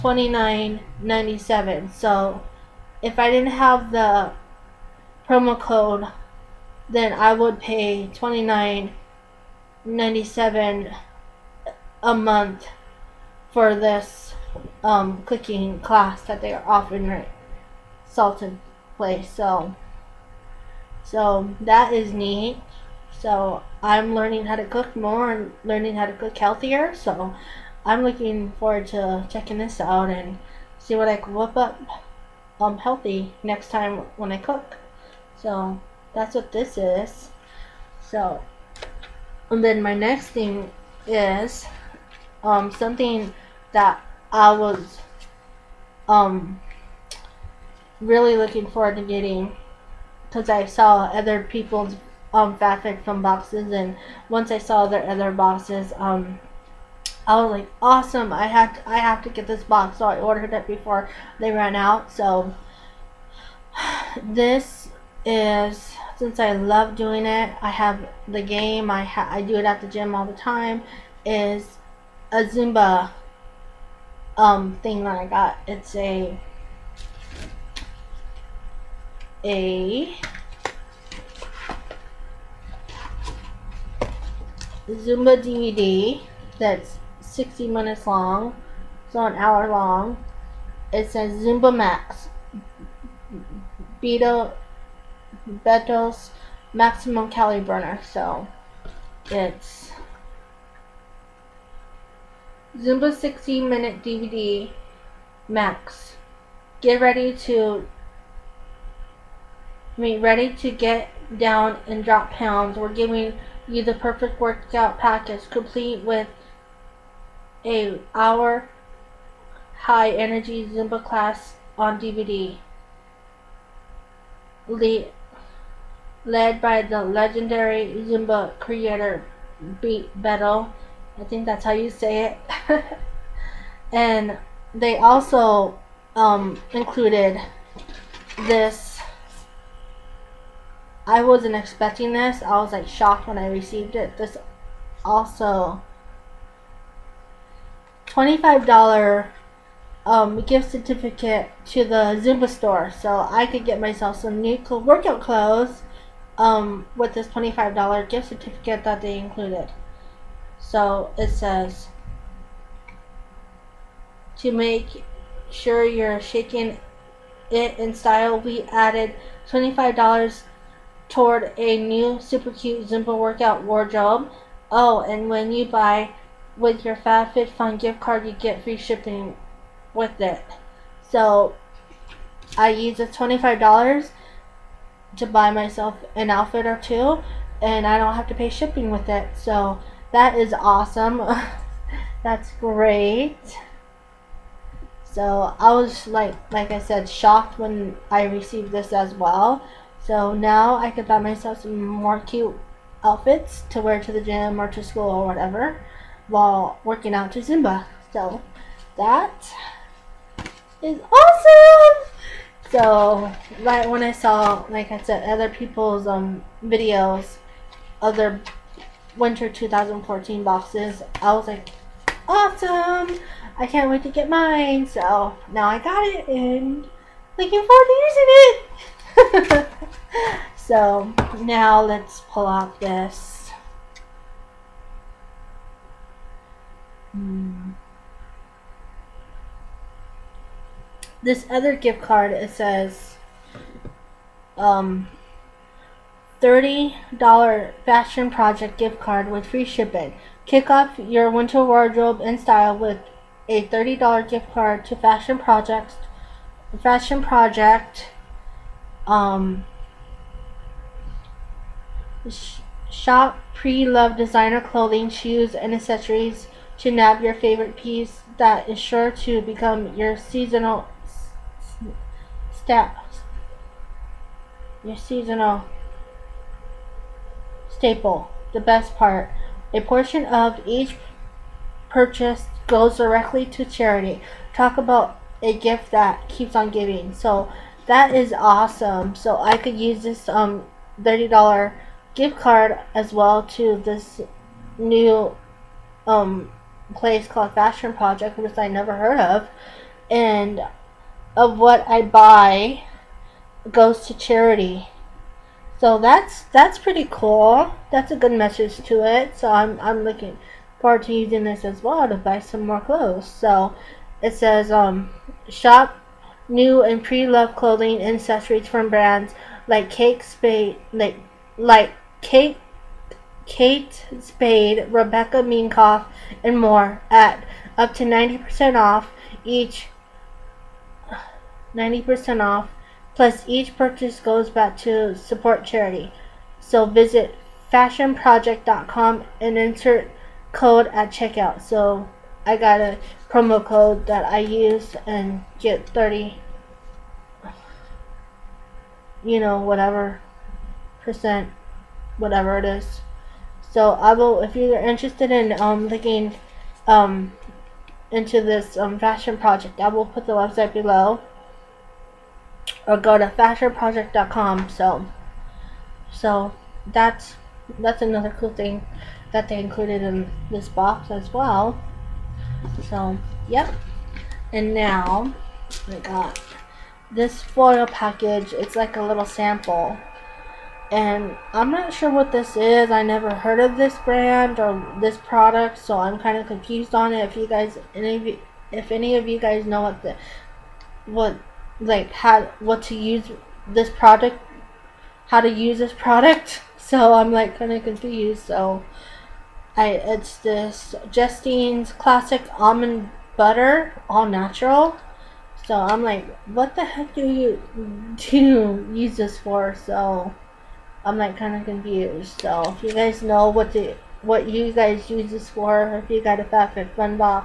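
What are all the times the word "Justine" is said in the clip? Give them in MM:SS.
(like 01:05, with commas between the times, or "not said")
06:41.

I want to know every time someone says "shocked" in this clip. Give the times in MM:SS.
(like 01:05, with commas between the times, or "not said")
02:22, 03:17.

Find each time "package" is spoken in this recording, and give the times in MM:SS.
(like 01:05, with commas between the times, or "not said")
01:54, 06:17.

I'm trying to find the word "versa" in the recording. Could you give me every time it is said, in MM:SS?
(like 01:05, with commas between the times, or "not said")
not said.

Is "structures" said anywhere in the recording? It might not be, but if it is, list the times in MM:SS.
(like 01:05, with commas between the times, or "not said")
not said.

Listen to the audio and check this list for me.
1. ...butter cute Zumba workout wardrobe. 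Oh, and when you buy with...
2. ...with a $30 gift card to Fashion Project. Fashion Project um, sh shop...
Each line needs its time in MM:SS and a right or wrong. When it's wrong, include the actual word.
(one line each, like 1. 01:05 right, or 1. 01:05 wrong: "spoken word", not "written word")
1. 02:52 wrong: "super", not "butter"
2. 04:12 right.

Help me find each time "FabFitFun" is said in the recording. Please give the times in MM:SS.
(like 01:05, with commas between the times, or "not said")
00:52, 02:56.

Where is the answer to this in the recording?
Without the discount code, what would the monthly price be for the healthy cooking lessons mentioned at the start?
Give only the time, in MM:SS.
00:08.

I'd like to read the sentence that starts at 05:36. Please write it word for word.
So visit fashionproject.com and insert code at checkout.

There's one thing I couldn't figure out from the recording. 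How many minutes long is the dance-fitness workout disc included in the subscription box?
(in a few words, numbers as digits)
60.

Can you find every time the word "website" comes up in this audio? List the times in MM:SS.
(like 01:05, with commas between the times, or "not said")
06:00.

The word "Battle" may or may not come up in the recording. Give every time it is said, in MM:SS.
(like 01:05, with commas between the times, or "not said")
02:10.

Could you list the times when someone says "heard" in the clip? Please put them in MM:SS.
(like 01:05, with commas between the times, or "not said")
04:58, 06:23.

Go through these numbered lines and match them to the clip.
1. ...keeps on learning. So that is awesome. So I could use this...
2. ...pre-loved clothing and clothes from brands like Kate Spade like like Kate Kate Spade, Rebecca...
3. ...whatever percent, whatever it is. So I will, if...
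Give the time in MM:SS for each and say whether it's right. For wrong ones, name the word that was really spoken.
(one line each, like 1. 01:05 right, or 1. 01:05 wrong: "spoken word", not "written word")
1. 04:46 wrong: "giving", not "learning"
2. 05:17 wrong: "accessories", not "clothes"
3. 05:49 right.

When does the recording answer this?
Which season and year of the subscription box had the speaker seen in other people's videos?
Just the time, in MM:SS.
03:39.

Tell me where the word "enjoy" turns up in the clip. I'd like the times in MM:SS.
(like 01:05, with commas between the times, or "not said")
not said.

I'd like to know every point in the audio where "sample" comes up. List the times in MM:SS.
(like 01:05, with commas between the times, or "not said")
06:19.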